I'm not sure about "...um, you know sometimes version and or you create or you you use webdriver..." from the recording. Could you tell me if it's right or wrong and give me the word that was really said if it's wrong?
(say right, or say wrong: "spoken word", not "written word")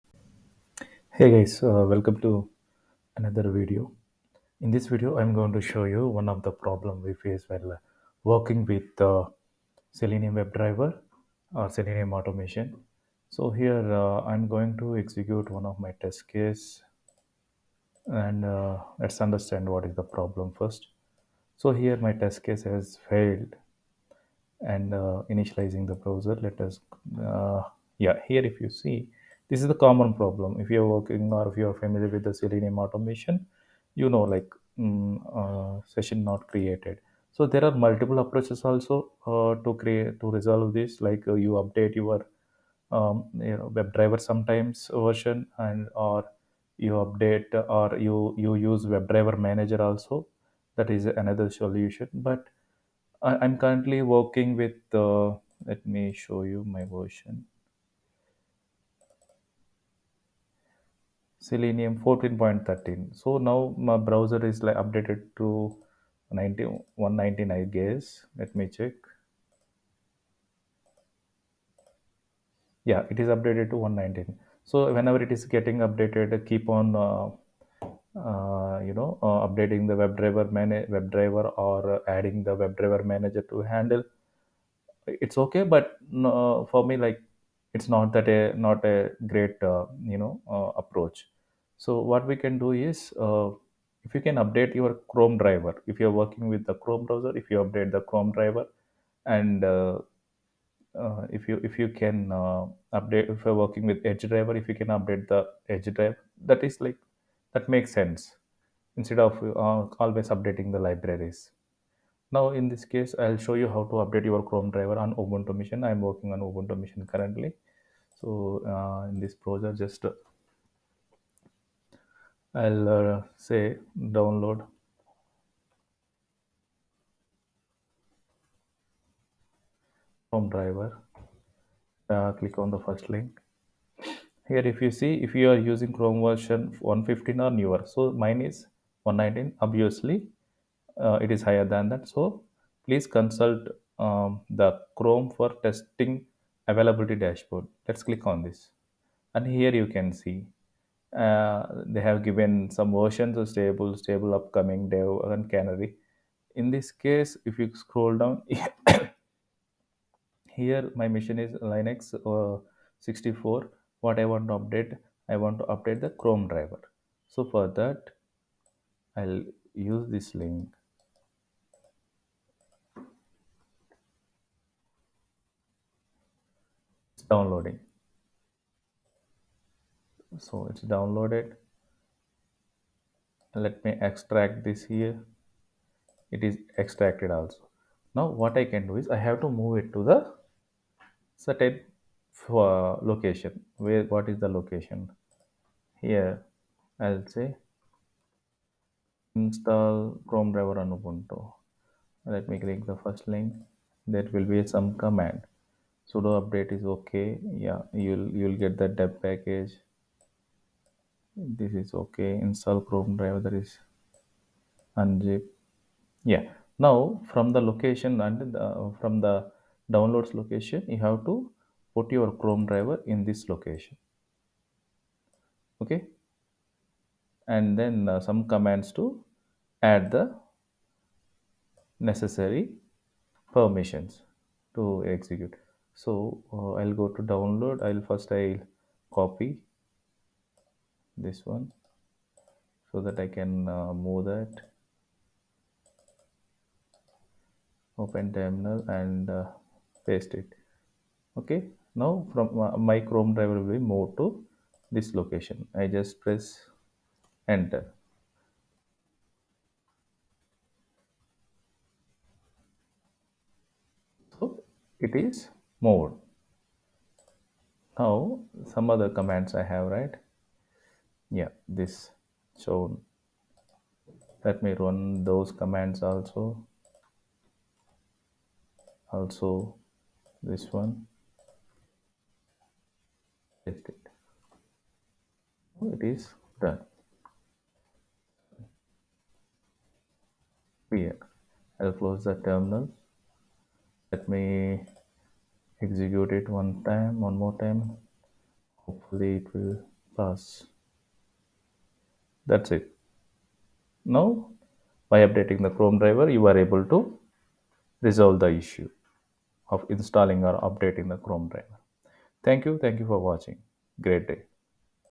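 wrong: "update", not "create".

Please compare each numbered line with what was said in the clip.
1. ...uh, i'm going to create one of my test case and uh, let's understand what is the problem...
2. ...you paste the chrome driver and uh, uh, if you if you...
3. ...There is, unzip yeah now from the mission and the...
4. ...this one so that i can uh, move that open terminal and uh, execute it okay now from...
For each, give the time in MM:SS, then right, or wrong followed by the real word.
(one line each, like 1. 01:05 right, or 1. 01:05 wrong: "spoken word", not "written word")
1. 00:13 wrong: "execute", not "create"
2. 01:37 wrong: "update", not "paste"
3. 03:33 wrong: "location", not "mission"
4. 04:01 wrong: "paste", not "execute".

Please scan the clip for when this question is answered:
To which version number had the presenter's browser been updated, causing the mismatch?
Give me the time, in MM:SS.
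01:13.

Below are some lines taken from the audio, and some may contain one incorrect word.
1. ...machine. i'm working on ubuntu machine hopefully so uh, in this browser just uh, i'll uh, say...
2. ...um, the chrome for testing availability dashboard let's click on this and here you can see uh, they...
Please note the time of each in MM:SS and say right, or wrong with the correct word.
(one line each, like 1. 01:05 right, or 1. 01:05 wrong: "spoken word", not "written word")
1. 01:55 wrong: "currently", not "hopefully"
2. 02:23 right.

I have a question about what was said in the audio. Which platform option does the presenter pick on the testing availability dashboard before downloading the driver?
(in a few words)
Linux 64.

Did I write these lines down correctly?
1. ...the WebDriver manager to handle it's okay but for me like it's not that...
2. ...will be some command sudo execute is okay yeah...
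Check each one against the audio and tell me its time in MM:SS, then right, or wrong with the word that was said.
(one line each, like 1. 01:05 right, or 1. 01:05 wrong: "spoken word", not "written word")
1. 01:22 right
2. 03:24 wrong: "update", not "execute".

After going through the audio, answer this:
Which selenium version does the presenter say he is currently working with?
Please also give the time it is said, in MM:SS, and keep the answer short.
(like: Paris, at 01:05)
14.13, at 01:01.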